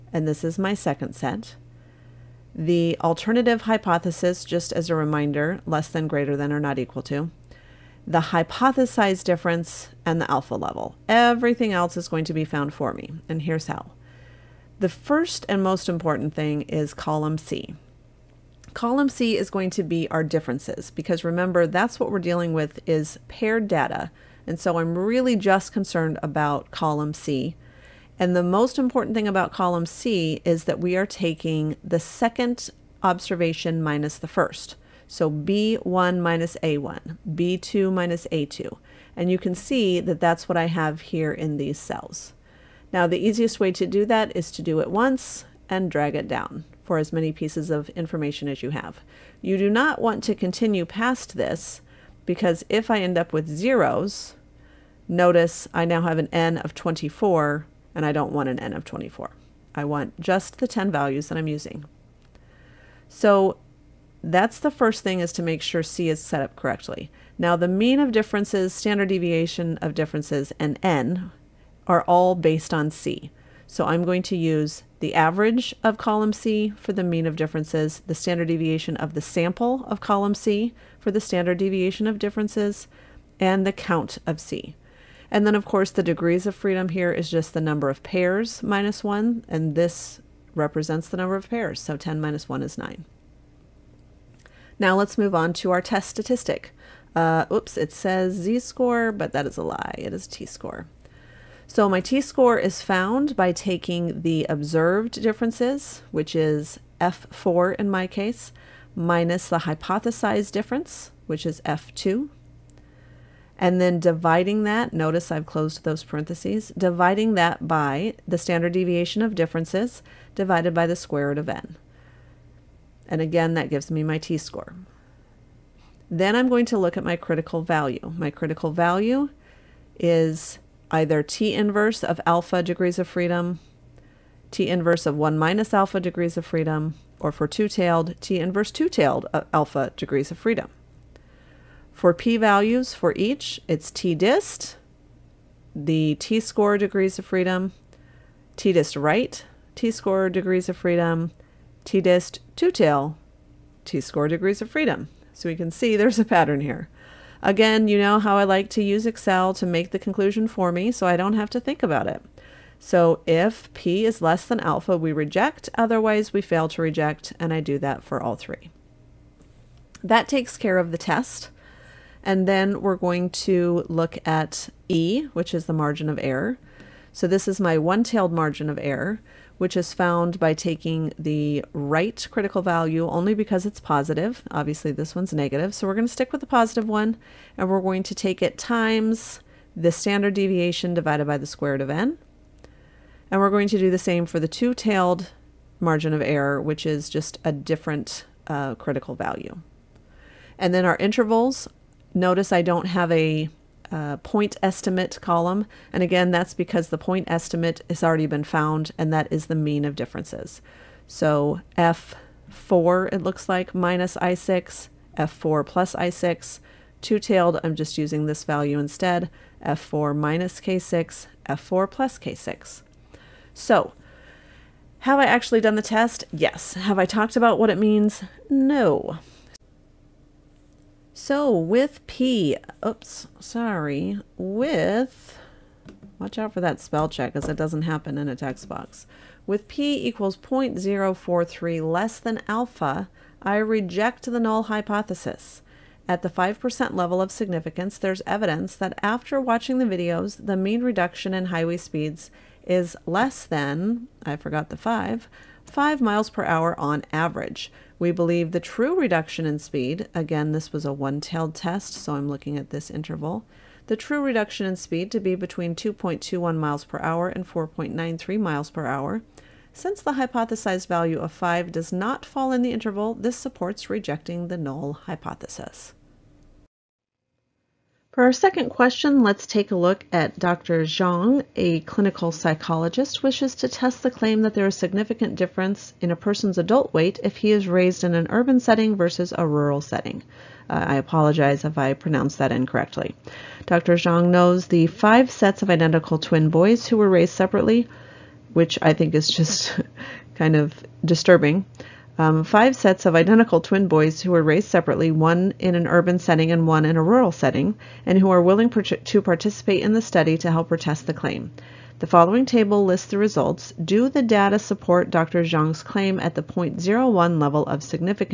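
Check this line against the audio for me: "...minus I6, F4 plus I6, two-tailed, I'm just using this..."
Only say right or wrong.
right.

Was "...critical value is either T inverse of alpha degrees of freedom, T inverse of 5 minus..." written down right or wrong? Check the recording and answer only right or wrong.
wrong.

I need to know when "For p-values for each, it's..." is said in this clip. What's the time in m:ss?
2:21.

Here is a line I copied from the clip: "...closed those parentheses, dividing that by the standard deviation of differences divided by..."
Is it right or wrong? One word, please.
right.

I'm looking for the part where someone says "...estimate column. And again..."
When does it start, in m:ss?
3:24.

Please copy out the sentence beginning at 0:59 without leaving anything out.
I want just the 10 values that I'm using.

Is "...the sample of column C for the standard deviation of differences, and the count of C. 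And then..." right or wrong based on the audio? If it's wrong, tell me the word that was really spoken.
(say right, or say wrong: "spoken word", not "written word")
right.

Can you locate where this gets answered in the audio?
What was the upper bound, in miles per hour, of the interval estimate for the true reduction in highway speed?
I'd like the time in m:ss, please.
4:27.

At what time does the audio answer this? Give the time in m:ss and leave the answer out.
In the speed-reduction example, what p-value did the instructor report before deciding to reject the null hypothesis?
4:00.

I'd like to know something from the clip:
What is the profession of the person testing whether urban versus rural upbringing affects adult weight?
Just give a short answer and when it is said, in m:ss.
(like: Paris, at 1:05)
Clinical psychologist, at 4:41.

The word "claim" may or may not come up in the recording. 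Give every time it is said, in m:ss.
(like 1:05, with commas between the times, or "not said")
4:44, 5:11, 5:15.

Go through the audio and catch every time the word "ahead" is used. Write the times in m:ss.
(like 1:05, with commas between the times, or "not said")
not said.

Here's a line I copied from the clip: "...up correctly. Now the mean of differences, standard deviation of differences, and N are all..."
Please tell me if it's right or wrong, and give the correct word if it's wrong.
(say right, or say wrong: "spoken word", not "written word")
right.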